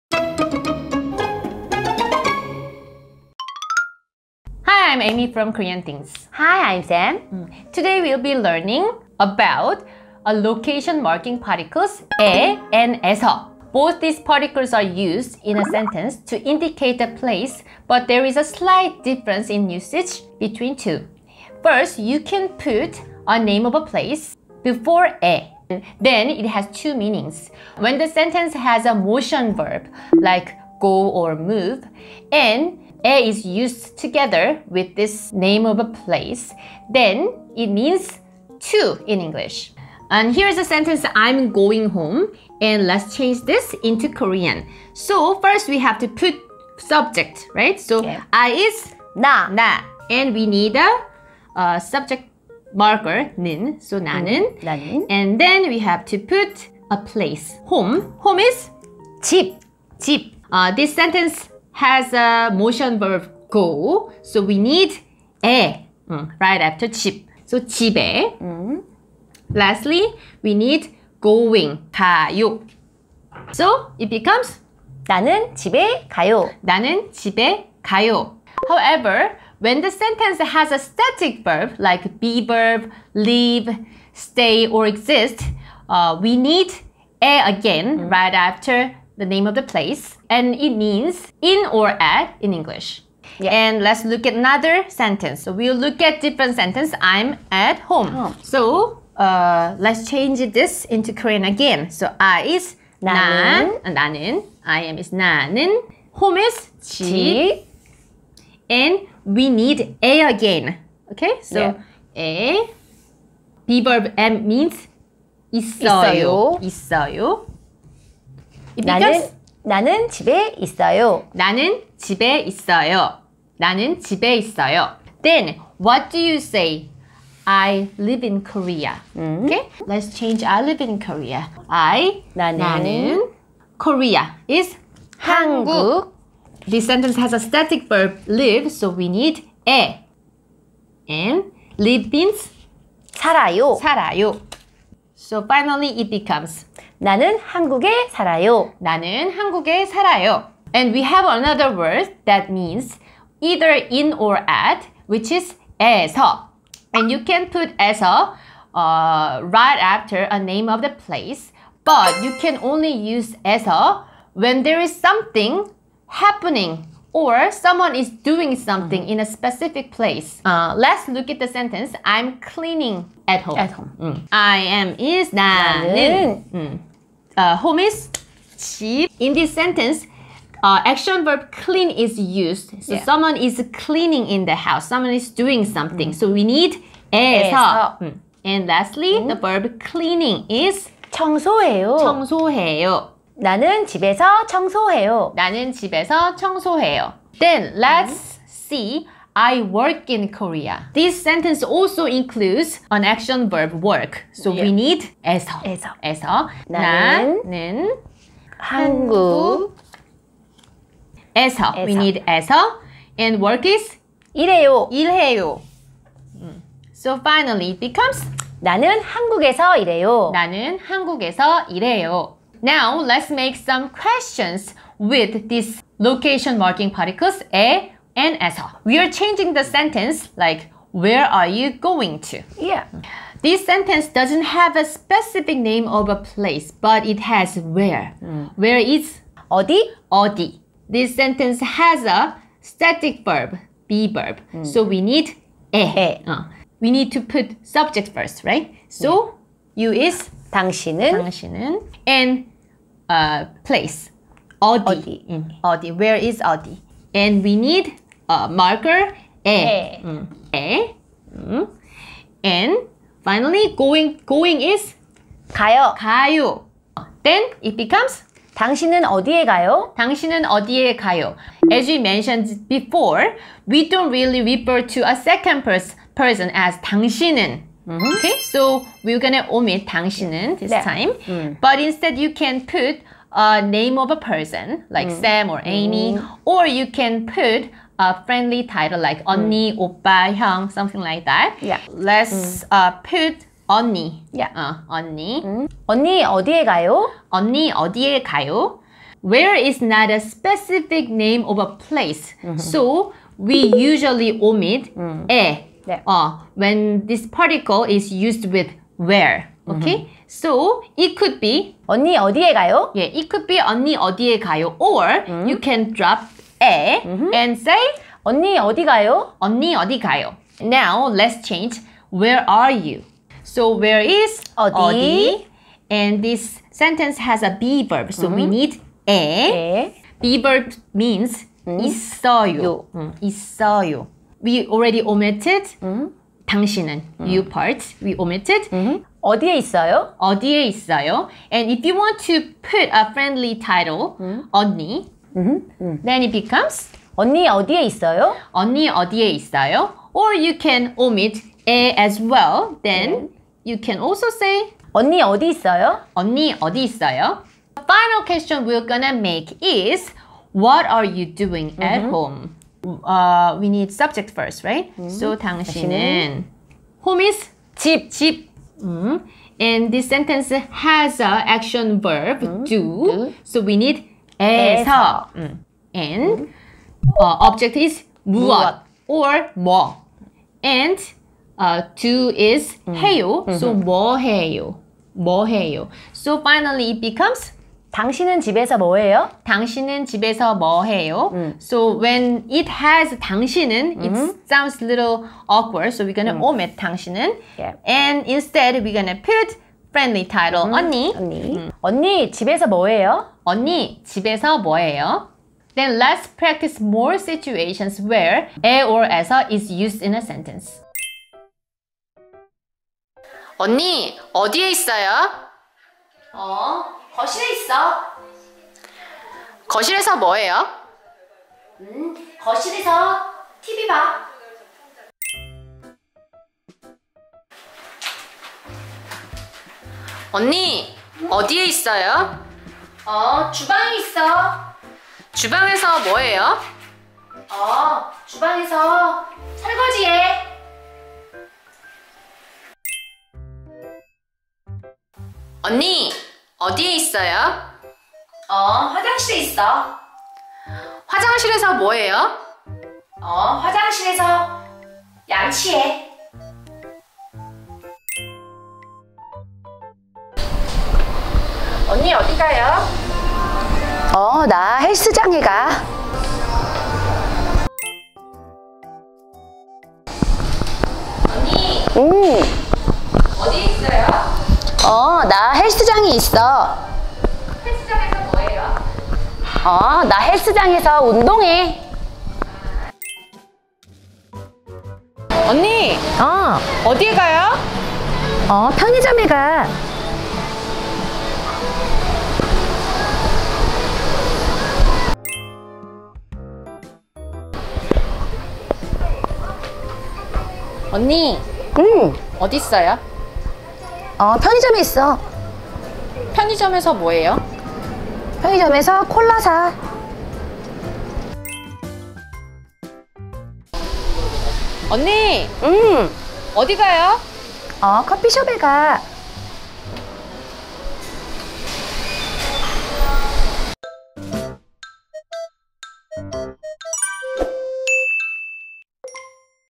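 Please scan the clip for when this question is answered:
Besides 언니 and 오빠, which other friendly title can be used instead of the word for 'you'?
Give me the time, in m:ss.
4:50.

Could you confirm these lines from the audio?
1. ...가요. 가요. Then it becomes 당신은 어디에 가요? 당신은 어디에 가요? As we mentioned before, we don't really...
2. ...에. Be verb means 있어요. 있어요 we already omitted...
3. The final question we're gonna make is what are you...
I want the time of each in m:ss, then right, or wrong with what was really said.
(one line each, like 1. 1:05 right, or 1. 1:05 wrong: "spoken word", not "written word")
1. 4:25 right
2. 5:29 right
3. 5:57 right.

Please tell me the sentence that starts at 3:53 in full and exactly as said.
This sentence doesn't have a specific name of a place, but it has where.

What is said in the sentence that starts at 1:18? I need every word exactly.
However, when the sentence has a static verb like be verb, leave, stay or exist, uh, we need 에 again mm.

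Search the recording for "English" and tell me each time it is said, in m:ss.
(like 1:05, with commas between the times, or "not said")
0:39, 1:32.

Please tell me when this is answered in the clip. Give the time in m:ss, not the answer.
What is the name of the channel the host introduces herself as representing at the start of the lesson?
0:05.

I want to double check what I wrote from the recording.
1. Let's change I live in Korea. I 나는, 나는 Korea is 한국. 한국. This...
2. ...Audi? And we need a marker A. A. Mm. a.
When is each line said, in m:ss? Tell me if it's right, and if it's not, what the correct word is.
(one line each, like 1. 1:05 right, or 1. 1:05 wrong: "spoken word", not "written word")
1. 2:09 right
2. 4:16 right.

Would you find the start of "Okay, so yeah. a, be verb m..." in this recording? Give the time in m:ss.
1:51.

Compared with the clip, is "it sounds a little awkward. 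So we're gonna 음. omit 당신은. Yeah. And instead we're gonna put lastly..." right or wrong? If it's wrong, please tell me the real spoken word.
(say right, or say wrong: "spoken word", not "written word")
wrong: "friendly", not "lastly".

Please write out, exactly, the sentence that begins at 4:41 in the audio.
but instead you can put a name of a person like mm.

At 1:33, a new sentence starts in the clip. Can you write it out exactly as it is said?
And let's look at another sentence.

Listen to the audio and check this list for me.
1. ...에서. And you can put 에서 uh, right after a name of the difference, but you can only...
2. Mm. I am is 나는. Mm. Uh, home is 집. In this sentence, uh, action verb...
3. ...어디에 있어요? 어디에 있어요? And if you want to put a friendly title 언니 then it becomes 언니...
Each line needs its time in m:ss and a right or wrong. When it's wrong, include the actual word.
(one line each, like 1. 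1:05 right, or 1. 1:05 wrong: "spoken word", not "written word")
1. 2:35 wrong: "place", not "difference"
2. 2:53 right
3. 5:39 right.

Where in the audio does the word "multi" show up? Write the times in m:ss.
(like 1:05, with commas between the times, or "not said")
not said.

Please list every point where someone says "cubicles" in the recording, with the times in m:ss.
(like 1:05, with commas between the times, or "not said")
not said.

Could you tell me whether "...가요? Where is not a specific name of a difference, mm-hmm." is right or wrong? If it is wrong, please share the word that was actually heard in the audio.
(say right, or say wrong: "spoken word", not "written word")
wrong: "place", not "difference".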